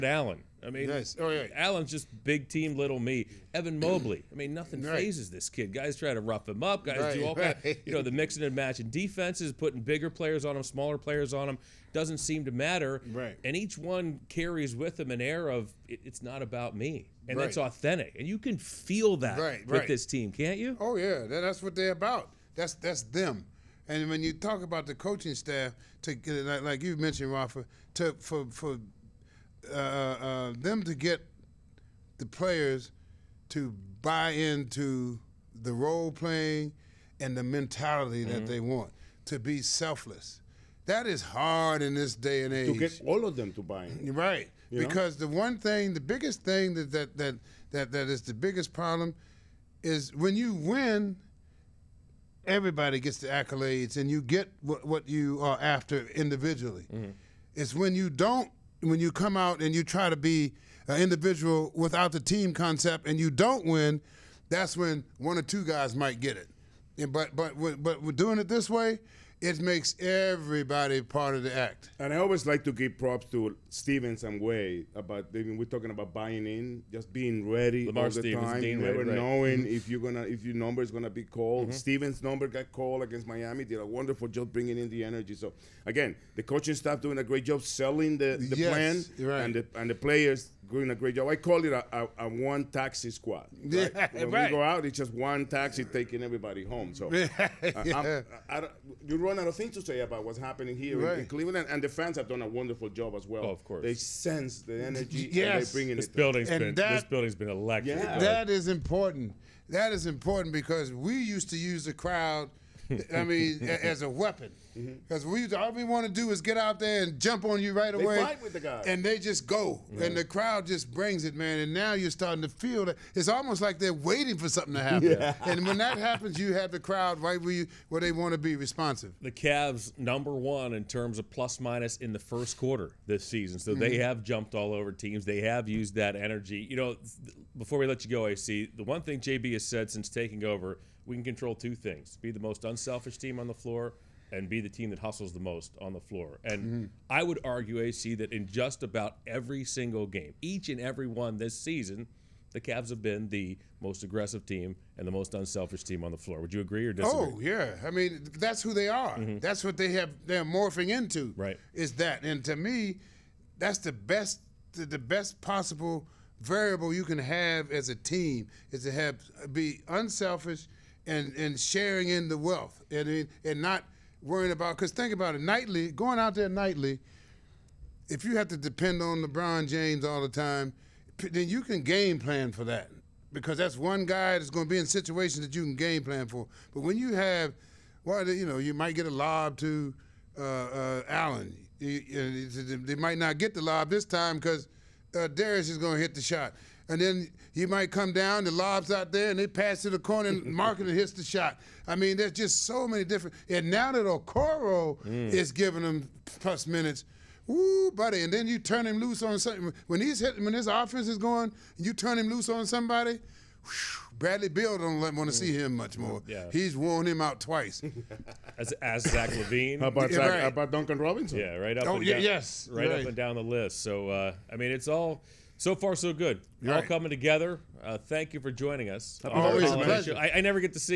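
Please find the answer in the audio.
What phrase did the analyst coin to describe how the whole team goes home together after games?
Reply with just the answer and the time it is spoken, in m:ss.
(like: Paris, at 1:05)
one taxi squad, at 1:32.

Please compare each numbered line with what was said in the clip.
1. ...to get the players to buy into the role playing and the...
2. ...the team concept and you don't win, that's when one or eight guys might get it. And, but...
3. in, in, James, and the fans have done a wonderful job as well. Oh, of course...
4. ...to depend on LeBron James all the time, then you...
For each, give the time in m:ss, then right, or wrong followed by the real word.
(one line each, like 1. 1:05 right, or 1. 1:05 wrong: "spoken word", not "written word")
1. 0:30 right
2. 1:02 wrong: "two", not "eight"
3. 1:41 wrong: "Cleveland", not "James"
4. 2:58 right.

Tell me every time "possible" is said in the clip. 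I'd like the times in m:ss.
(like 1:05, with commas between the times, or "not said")
2:45.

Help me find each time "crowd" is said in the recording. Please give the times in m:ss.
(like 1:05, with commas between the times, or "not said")
1:51, 2:00, 2:06.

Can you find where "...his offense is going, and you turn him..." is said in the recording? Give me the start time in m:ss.
3:30.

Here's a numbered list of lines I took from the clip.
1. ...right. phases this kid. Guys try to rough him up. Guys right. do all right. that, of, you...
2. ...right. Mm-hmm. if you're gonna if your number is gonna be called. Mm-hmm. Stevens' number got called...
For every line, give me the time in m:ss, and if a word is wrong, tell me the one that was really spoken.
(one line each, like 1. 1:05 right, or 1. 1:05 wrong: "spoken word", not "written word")
1. 0:04 right
2. 1:19 right.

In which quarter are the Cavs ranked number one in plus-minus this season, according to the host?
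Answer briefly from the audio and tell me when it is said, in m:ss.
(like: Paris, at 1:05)
First quarter, at 2:12.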